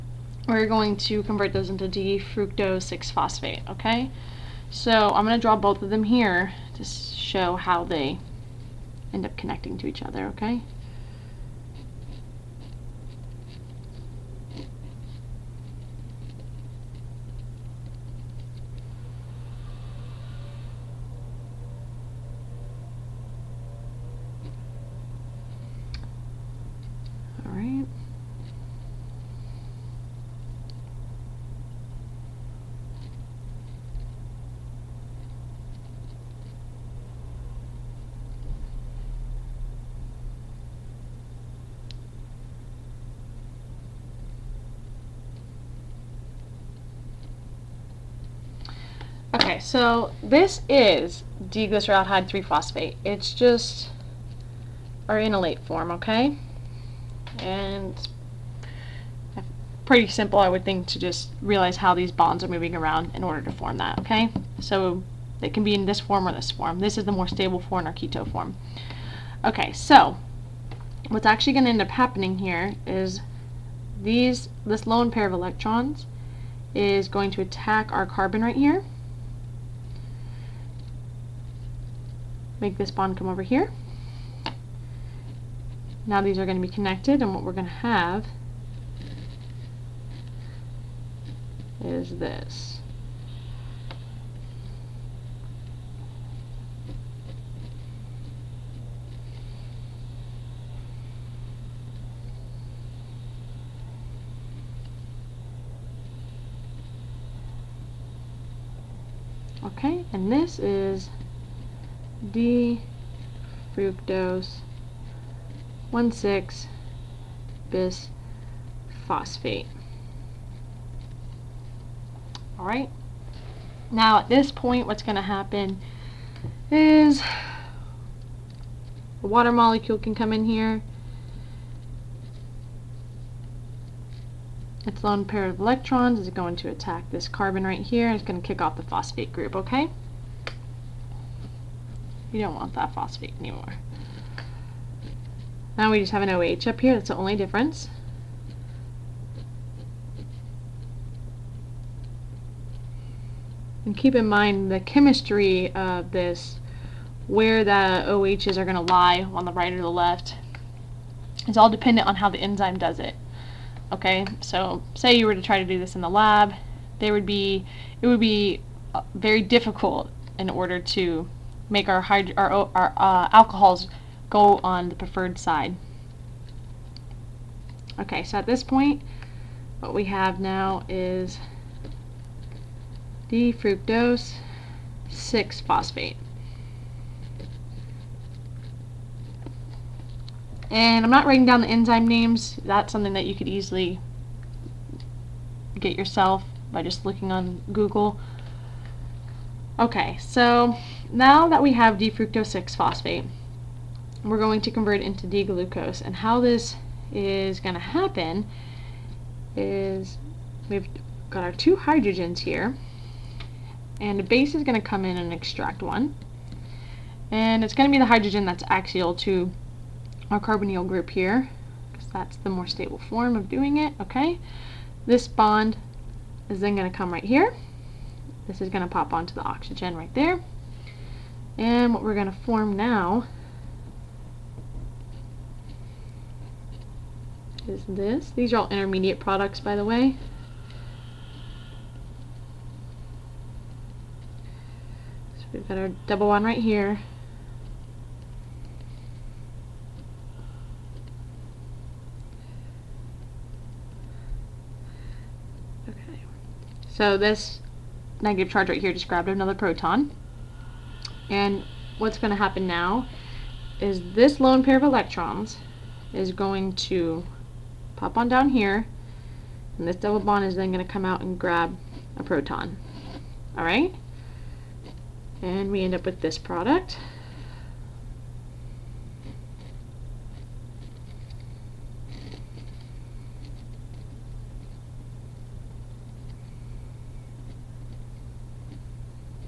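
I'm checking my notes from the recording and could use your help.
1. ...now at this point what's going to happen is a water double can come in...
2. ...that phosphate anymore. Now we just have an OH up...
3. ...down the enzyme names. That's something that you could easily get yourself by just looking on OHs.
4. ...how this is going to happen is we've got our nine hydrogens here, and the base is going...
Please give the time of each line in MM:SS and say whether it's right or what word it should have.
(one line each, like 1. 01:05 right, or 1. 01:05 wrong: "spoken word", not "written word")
1. 02:03 wrong: "molecule", not "double"
2. 02:22 right
3. 03:11 wrong: "Google", not "OHs"
4. 03:26 wrong: "two", not "nine".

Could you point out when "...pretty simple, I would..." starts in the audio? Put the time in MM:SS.
00:59.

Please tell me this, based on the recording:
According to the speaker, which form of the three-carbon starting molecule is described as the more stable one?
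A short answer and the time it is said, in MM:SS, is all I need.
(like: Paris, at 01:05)
keto form, at 01:07.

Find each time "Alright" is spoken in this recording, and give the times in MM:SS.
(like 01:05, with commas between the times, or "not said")
02:02, 04:33.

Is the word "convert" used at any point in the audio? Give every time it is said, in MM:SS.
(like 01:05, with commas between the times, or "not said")
00:01, 03:24.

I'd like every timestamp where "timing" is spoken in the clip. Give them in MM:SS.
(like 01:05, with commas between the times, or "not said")
not said.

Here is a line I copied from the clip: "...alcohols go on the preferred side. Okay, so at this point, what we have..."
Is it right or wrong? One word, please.
right.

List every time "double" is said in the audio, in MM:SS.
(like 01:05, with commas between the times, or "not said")
04:06, 04:29.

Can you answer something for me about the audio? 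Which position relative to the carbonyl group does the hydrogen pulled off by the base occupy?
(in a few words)
axial.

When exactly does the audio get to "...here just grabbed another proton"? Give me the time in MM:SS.
04:18.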